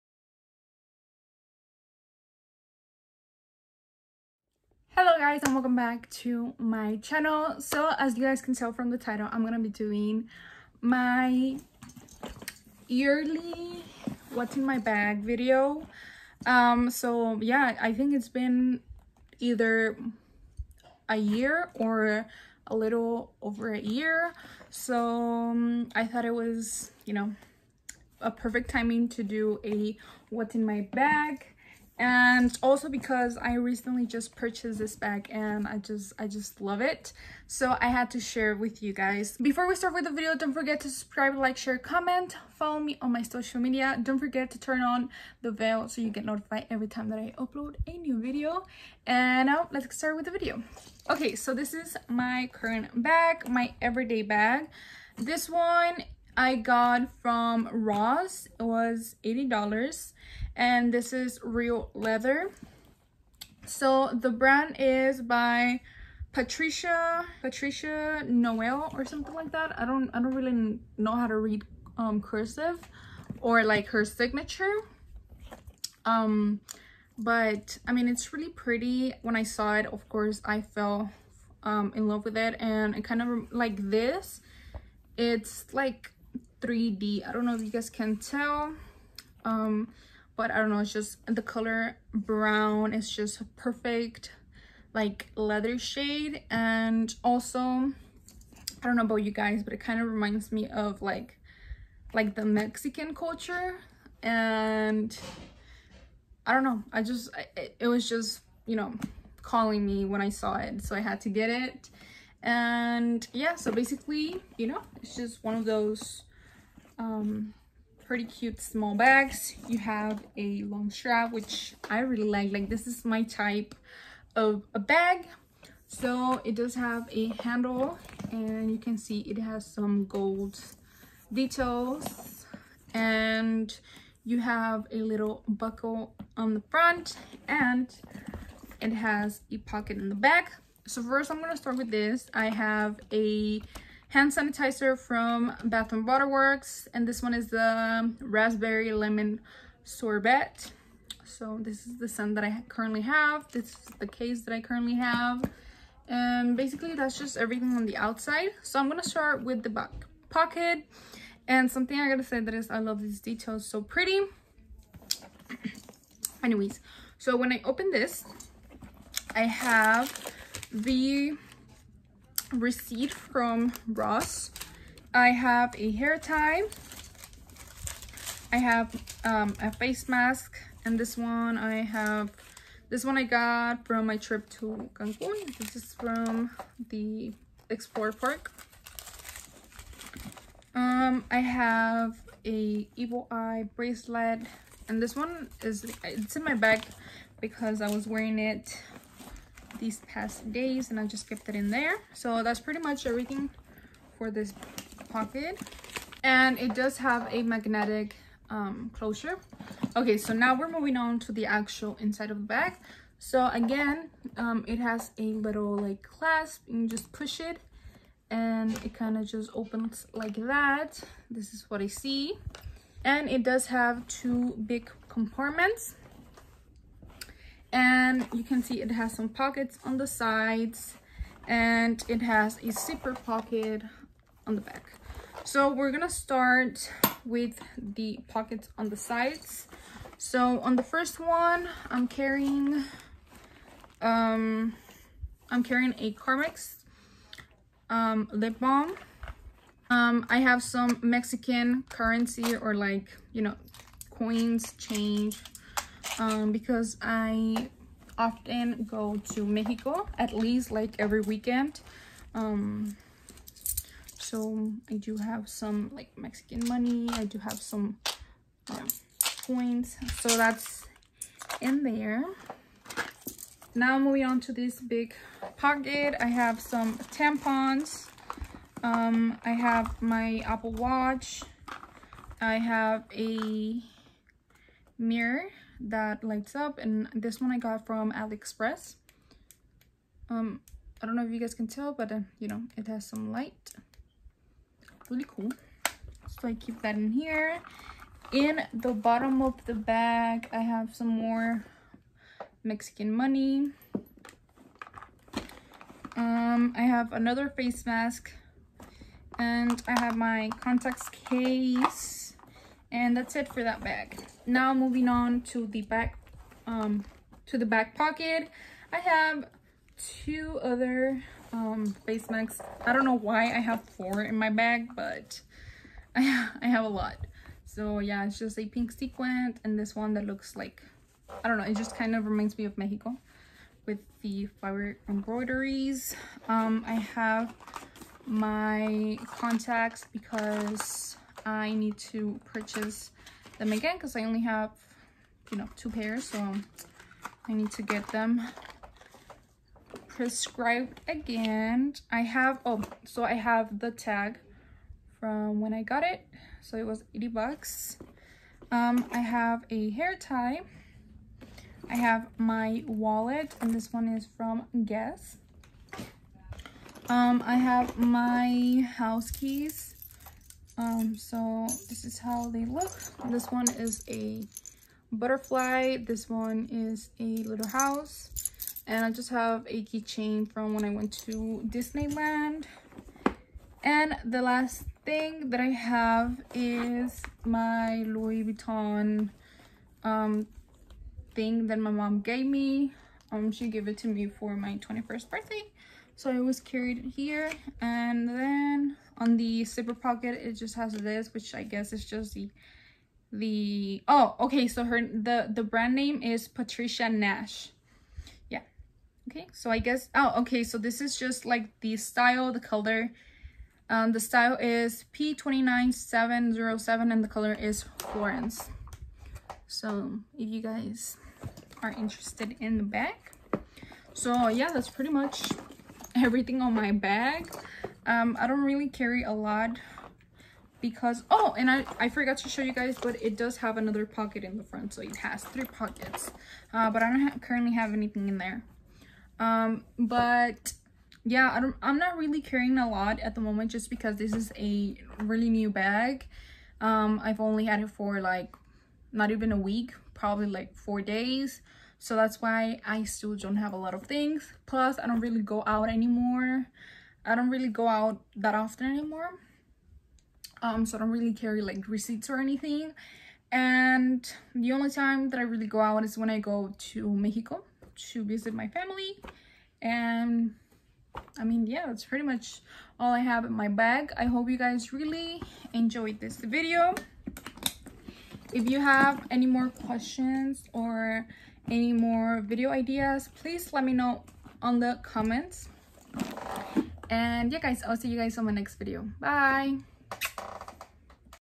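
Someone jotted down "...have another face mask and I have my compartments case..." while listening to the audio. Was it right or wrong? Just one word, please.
wrong.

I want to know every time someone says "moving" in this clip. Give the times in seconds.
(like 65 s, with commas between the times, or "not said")
210 s, 273 s, 314 s.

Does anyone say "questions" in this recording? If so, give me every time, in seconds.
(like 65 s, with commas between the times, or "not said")
479 s.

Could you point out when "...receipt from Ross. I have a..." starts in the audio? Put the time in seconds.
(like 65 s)
172 s.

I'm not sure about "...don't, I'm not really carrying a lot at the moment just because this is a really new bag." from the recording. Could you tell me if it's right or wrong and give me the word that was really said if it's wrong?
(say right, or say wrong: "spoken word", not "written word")
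right.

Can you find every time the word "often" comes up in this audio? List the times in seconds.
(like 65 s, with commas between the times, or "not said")
258 s, 458 s.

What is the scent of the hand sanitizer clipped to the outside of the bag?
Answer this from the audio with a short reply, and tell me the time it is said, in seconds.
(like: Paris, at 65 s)
Raspberry lemon sorbet, at 148 s.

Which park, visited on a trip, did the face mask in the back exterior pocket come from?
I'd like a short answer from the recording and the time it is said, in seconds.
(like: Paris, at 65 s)
Xplor Park, at 187 s.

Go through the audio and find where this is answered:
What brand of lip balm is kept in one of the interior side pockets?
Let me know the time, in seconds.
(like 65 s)
246 s.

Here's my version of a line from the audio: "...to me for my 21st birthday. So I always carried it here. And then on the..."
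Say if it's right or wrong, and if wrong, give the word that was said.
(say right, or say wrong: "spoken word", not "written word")
right.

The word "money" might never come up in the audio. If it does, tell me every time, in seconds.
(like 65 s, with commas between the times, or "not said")
266 s, 303 s.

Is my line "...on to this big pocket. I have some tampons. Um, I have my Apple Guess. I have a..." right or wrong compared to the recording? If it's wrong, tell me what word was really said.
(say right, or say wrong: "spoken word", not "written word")
wrong: "Watch", not "Guess".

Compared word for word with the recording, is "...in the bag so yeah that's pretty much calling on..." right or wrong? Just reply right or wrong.
wrong.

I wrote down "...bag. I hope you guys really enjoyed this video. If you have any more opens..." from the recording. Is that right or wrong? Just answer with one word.
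wrong.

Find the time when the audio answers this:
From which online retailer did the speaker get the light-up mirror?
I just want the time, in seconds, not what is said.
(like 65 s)
288 s.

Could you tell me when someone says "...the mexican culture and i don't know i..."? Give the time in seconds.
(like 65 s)
102 s.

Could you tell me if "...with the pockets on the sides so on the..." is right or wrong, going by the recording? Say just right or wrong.
right.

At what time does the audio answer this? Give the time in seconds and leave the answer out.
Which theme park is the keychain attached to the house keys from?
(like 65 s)
381 s.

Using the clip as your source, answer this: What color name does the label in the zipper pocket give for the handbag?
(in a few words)
Florence.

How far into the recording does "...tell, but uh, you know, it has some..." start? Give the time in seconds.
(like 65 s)
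291 s.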